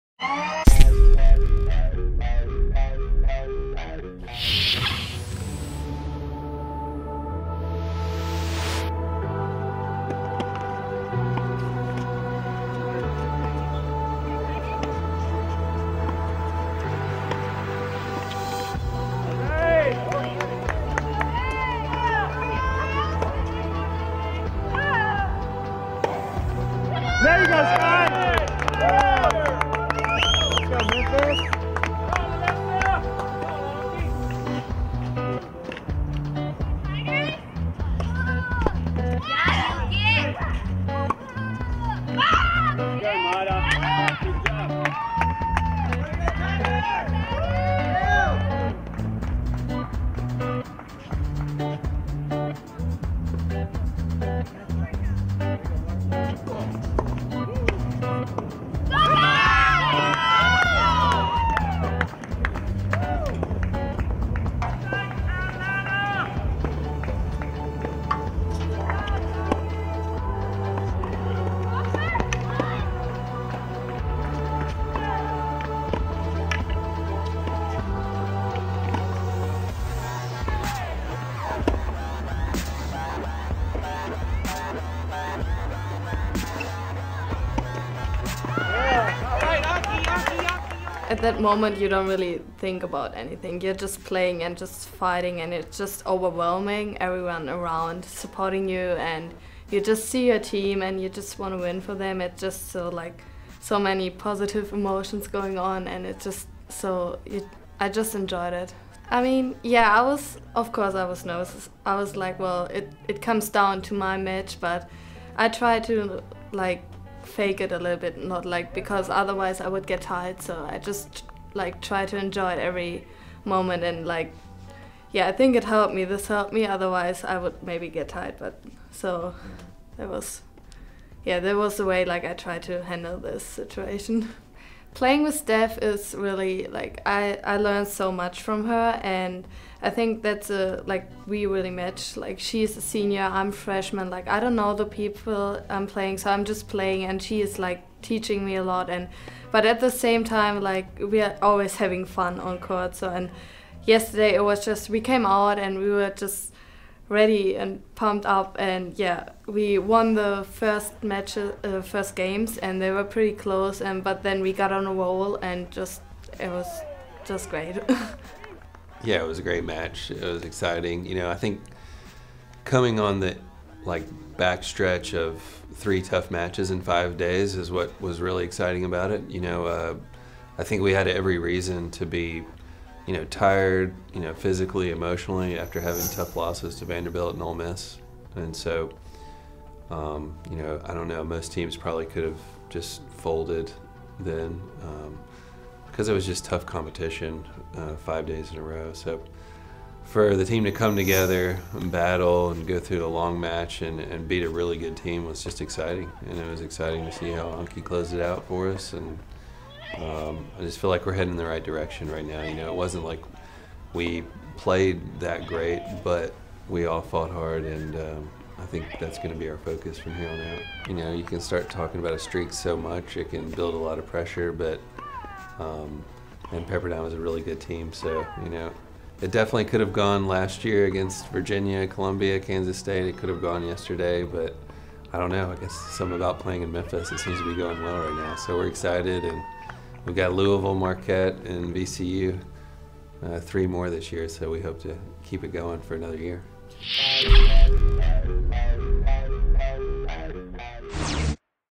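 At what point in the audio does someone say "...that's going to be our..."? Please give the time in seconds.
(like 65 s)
218 s.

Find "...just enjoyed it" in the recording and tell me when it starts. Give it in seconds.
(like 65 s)
107 s.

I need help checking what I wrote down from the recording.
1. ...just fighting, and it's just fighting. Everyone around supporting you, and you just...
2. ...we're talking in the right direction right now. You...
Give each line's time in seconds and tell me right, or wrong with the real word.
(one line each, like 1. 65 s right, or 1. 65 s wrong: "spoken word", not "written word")
1. 94 s wrong: "overwhelming", not "fighting"
2. 211 s wrong: "heading", not "talking".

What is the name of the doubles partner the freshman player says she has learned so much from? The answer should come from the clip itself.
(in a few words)
Steph.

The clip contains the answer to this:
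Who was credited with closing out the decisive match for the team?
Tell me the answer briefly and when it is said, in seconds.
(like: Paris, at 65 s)
Anki, at 207 s.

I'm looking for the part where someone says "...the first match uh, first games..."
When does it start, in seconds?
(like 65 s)
160 s.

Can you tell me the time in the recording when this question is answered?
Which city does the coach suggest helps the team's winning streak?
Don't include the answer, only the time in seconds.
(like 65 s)
236 s.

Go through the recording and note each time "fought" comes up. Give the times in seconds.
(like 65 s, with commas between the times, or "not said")
217 s.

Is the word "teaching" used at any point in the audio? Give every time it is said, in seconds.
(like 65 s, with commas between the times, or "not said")
148 s.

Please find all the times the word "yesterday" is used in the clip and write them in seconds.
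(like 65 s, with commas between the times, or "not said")
153 s, 233 s.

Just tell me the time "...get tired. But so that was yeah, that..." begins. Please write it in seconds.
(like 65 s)
127 s.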